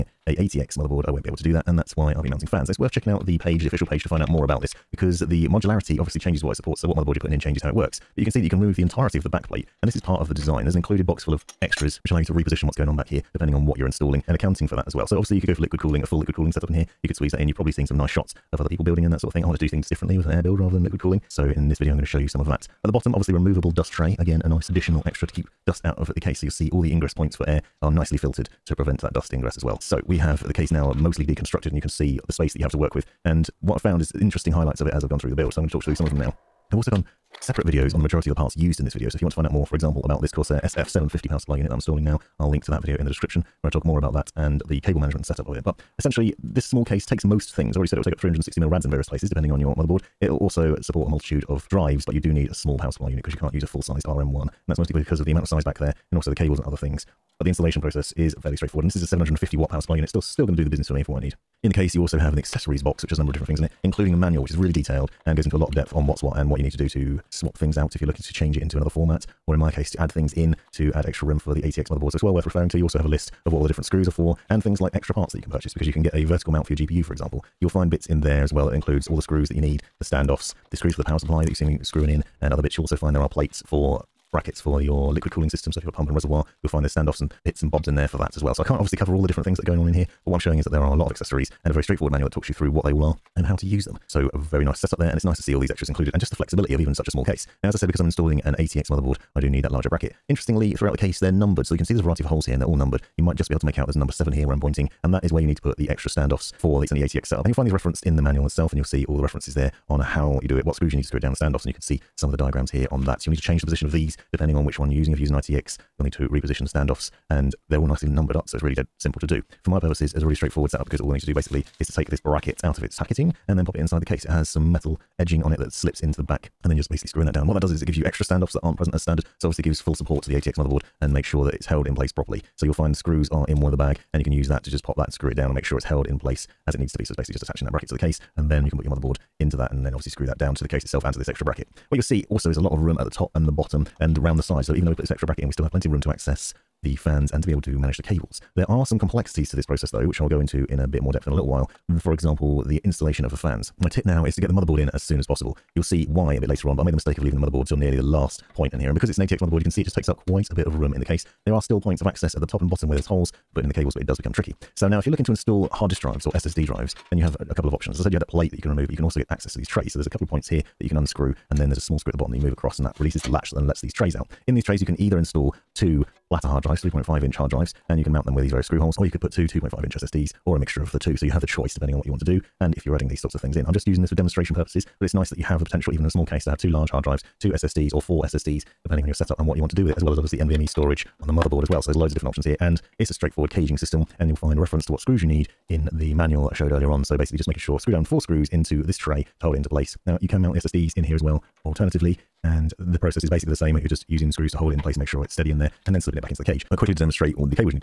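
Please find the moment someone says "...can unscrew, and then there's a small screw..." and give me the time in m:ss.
2:50.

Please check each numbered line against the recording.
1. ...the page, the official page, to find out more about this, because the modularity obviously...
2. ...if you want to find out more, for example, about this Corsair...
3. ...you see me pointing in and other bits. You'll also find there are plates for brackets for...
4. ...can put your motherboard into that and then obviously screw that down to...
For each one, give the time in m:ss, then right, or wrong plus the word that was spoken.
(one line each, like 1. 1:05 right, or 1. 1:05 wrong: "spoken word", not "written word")
1. 0:03 right
2. 0:39 right
3. 1:21 wrong: "screwing", not "pointing"
4. 2:18 right.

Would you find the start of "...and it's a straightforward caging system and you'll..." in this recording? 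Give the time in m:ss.
3:12.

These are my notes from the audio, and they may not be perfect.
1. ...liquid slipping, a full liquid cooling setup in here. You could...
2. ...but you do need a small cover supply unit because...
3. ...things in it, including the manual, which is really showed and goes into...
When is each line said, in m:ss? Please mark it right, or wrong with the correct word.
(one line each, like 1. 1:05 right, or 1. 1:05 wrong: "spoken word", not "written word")
1. 0:15 wrong: "cooling", not "slipping"
2. 0:52 wrong: "power", not "cover"
3. 1:03 wrong: "detailed", not "showed".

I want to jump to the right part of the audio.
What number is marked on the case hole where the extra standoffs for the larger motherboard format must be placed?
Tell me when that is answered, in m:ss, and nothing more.
1:43.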